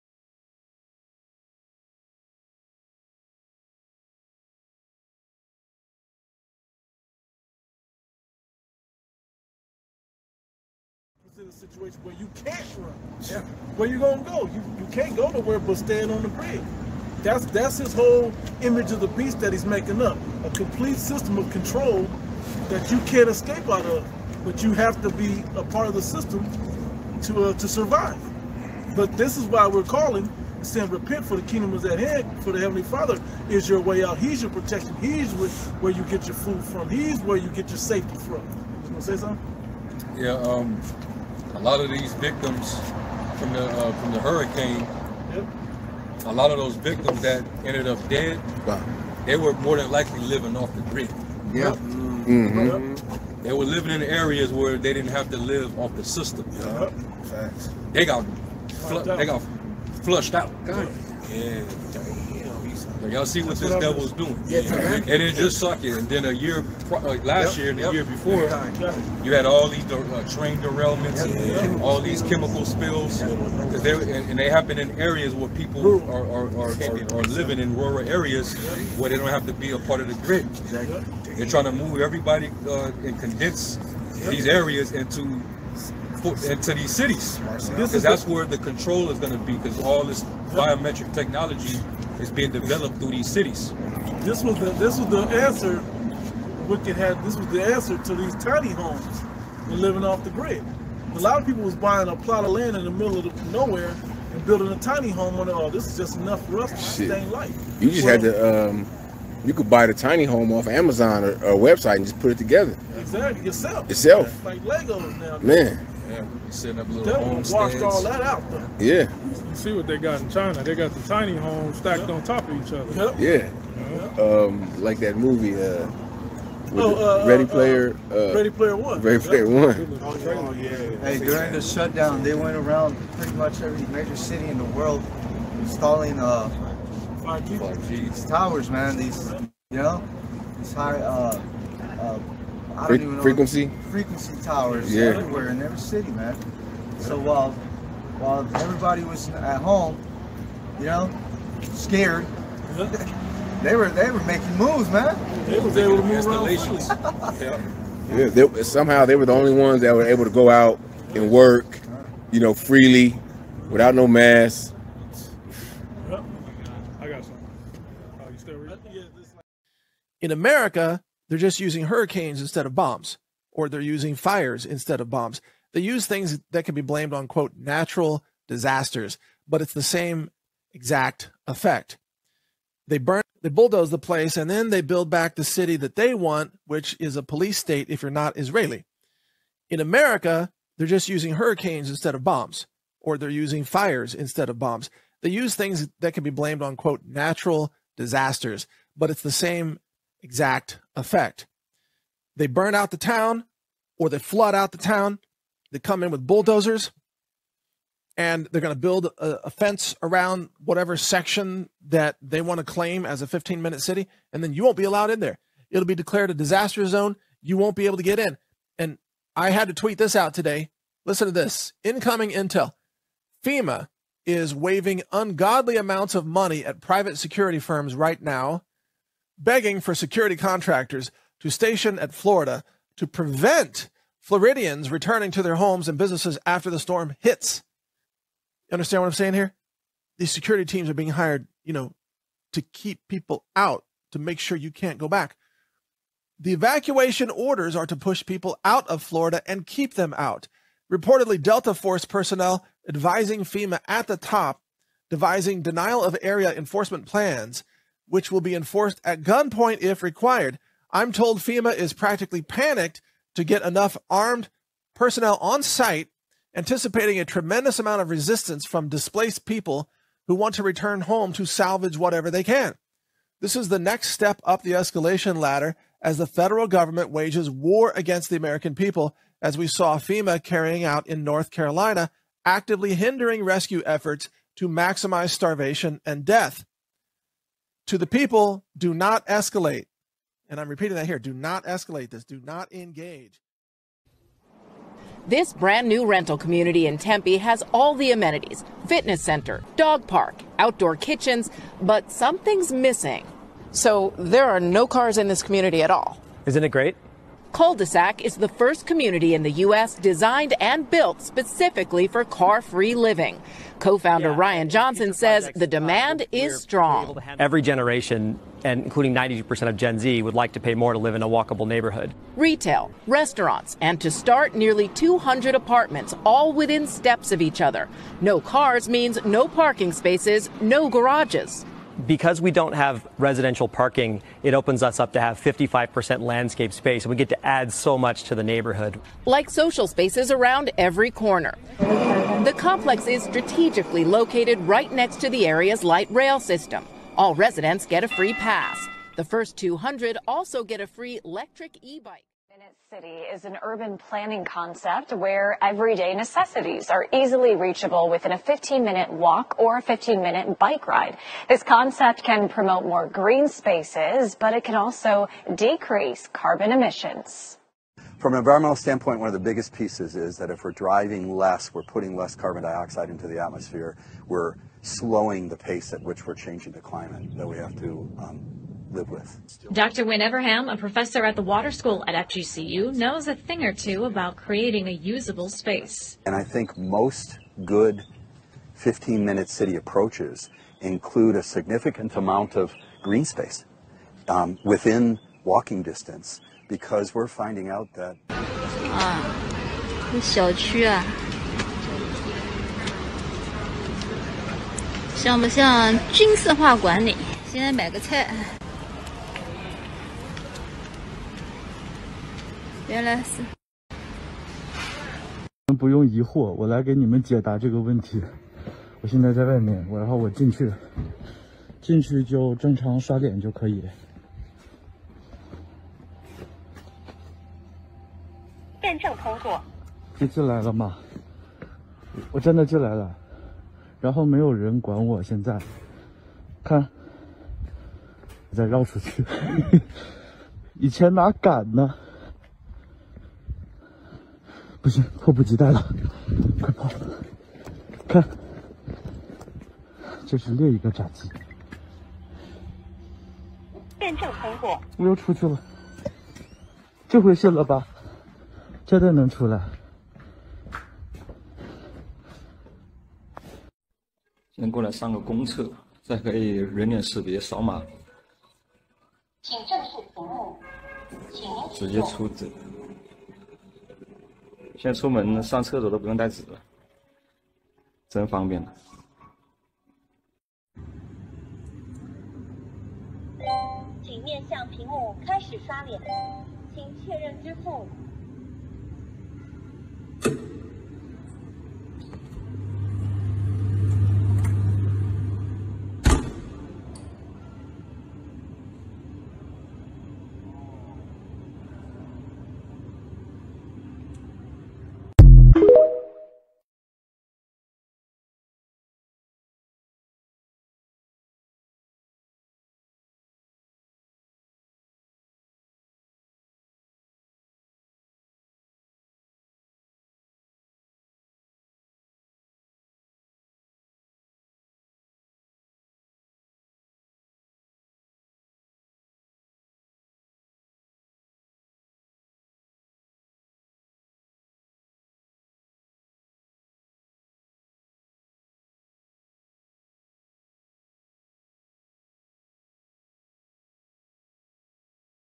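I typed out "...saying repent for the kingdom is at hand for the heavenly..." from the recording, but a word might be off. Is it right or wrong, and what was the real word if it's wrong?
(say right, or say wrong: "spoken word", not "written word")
right.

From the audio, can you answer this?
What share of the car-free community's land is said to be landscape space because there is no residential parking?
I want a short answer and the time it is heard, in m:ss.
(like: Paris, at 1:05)
55%, at 5:35.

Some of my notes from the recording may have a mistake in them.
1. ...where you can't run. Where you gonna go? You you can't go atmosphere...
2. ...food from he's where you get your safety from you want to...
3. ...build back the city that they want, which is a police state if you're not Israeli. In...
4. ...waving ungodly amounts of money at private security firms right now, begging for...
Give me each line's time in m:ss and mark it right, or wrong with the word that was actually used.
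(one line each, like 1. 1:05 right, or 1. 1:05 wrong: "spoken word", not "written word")
1. 0:12 wrong: "nowhere", not "atmosphere"
2. 0:36 right
3. 3:04 right
4. 3:44 right.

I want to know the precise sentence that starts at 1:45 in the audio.
Oh, this is just enough for us to sustain life.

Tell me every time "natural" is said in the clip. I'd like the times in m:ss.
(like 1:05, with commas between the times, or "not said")
2:57, 3:17.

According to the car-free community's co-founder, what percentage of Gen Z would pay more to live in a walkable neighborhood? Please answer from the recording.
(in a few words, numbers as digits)
92%.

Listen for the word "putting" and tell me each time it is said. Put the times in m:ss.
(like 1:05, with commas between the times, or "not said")
6:11.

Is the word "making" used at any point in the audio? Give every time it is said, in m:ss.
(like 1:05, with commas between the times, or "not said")
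0:19, 2:34.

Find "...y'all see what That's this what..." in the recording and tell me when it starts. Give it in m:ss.
1:03.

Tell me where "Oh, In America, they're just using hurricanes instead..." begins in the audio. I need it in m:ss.
2:46.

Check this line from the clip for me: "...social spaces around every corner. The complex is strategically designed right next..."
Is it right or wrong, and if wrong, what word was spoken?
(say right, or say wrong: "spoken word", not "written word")
wrong: "located", not "designed".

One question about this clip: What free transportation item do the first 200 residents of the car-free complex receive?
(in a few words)
electric e-bike.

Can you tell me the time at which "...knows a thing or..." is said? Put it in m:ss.
6:22.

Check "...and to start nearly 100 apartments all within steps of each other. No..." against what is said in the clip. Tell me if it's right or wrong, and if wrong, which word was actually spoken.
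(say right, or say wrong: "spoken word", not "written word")
wrong: "200", not "100".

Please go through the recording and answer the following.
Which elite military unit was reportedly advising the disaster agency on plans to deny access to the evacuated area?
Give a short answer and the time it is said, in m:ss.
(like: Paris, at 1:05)
Delta Force, at 4:11.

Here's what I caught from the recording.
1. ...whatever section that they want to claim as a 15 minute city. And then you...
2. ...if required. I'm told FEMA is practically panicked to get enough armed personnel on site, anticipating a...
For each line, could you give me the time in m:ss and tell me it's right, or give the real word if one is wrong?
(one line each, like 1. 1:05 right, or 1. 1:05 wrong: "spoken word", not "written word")
1. 3:30 right
2. 4:19 right.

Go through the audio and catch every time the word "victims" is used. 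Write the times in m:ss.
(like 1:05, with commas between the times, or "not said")
0:42, 0:46.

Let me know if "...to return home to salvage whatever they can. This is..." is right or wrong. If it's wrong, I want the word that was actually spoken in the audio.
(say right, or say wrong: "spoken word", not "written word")
right.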